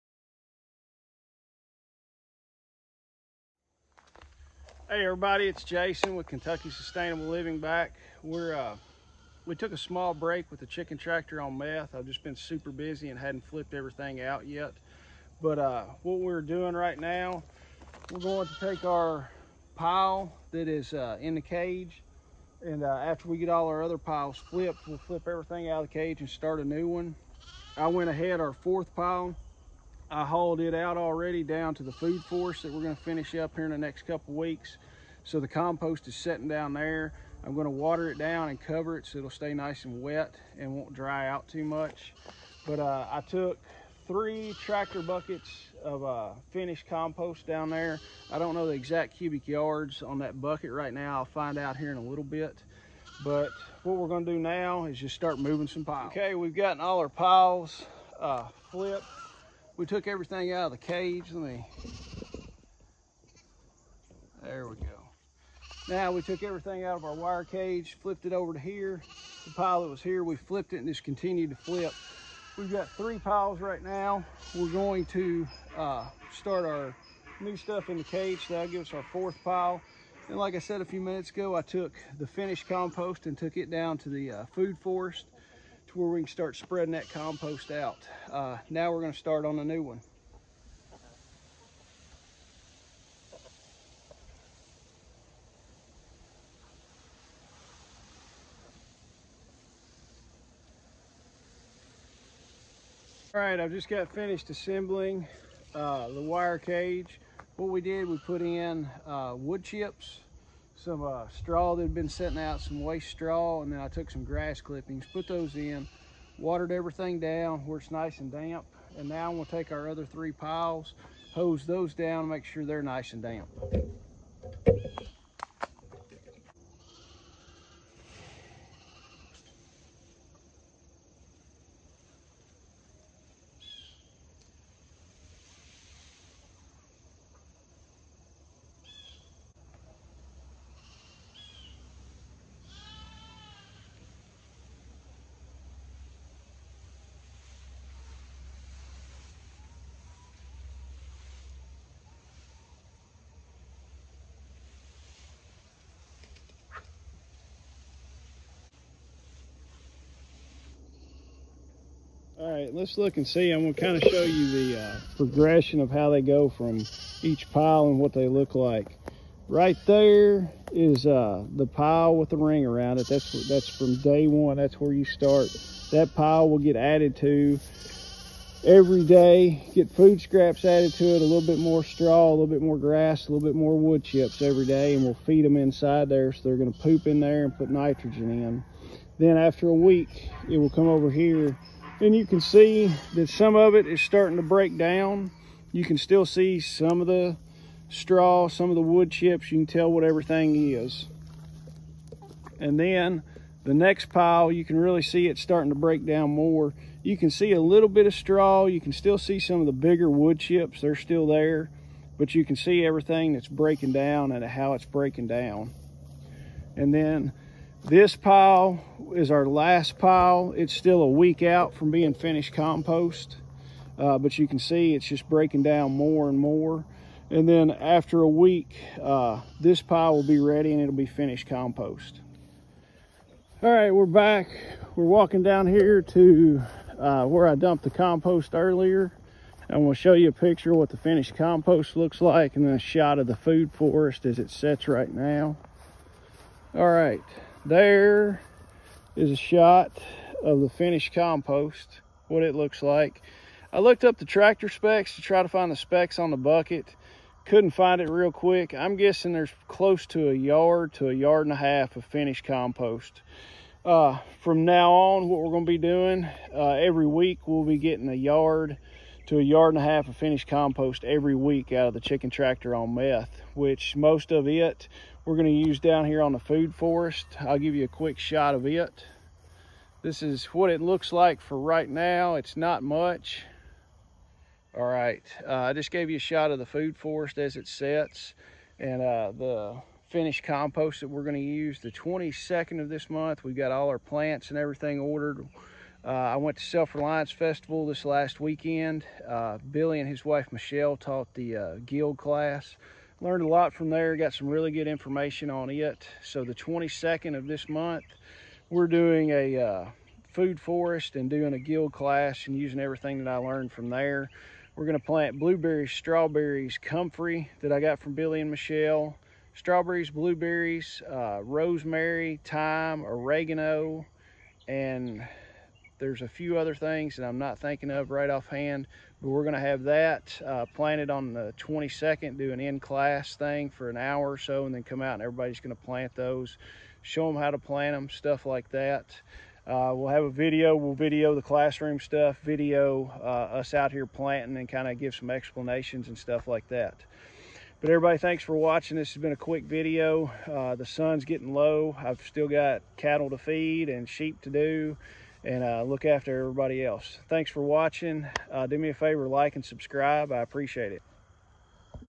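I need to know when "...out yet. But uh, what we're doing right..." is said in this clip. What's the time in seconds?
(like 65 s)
14 s.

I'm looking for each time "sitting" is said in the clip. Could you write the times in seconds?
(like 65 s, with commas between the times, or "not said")
36 s, 112 s.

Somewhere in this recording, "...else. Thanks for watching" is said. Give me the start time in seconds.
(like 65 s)
356 s.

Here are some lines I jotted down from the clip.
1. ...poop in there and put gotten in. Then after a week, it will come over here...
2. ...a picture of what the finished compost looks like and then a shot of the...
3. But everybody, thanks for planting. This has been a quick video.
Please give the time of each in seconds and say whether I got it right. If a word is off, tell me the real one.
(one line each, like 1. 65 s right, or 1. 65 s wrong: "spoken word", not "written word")
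1. 186 s wrong: "nitrogen", not "gotten"
2. 240 s right
3. 347 s wrong: "watching", not "planting".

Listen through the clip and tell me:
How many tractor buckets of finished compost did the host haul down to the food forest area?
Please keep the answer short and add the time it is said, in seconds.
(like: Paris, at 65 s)
3, at 44 s.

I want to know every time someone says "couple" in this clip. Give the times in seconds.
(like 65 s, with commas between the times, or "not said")
34 s.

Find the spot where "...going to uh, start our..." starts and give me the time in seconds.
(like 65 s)
74 s.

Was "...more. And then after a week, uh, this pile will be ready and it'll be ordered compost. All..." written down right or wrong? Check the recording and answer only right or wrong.
wrong.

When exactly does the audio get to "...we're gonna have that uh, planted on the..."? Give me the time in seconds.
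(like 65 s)
329 s.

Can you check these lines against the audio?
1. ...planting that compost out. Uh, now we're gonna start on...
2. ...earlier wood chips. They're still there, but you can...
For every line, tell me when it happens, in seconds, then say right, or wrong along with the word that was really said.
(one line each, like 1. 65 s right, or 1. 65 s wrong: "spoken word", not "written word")
1. 86 s wrong: "spreading", not "planting"
2. 209 s wrong: "bigger", not "earlier".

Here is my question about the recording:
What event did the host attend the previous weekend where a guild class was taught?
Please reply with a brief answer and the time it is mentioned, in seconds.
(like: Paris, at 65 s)
Self-Reliance Festival, at 296 s.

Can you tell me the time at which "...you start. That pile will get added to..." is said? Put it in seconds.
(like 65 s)
174 s.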